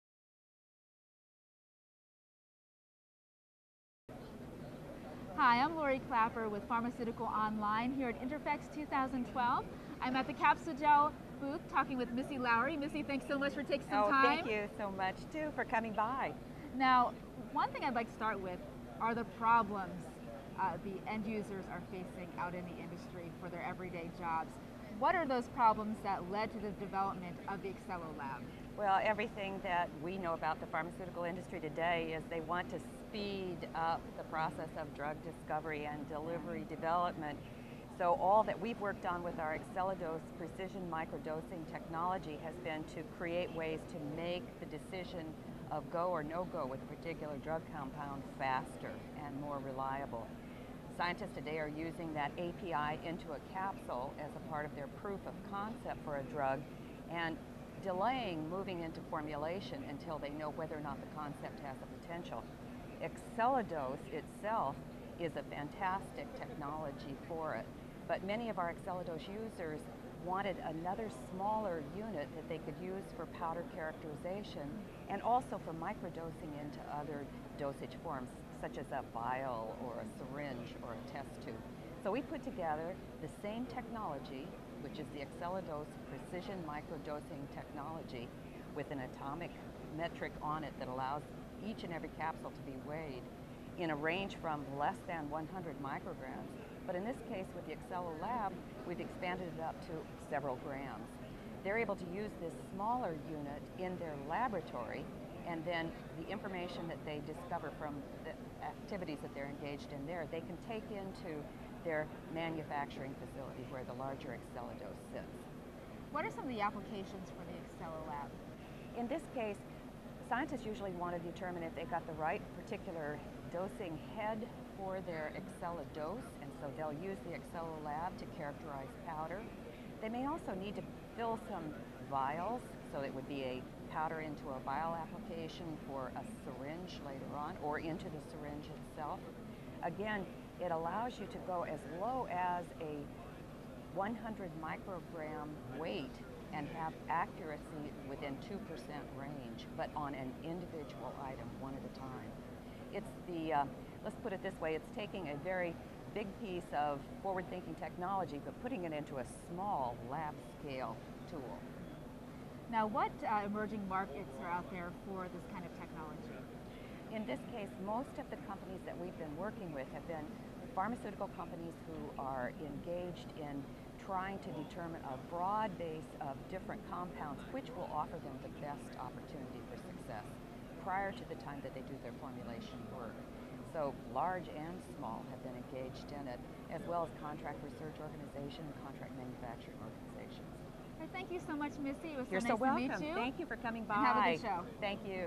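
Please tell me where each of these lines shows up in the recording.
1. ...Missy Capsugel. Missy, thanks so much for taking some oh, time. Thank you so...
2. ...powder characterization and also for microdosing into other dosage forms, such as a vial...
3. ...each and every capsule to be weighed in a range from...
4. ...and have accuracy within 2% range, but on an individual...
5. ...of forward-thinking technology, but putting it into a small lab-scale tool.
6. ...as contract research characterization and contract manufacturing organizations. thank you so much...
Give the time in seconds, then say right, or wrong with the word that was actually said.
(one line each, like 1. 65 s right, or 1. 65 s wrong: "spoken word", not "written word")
1. 12 s wrong: "Lowery", not "Capsugel"
2. 73 s right
3. 91 s right
4. 146 s right
5. 156 s right
6. 187 s wrong: "organization", not "characterization".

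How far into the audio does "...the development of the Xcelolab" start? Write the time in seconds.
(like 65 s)
26 s.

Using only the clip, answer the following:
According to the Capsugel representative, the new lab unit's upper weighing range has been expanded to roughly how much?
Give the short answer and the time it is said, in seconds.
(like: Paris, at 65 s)
several grams, at 100 s.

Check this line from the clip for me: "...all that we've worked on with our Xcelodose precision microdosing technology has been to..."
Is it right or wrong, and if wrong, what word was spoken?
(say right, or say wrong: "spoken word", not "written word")
right.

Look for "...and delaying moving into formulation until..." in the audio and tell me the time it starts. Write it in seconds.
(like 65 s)
57 s.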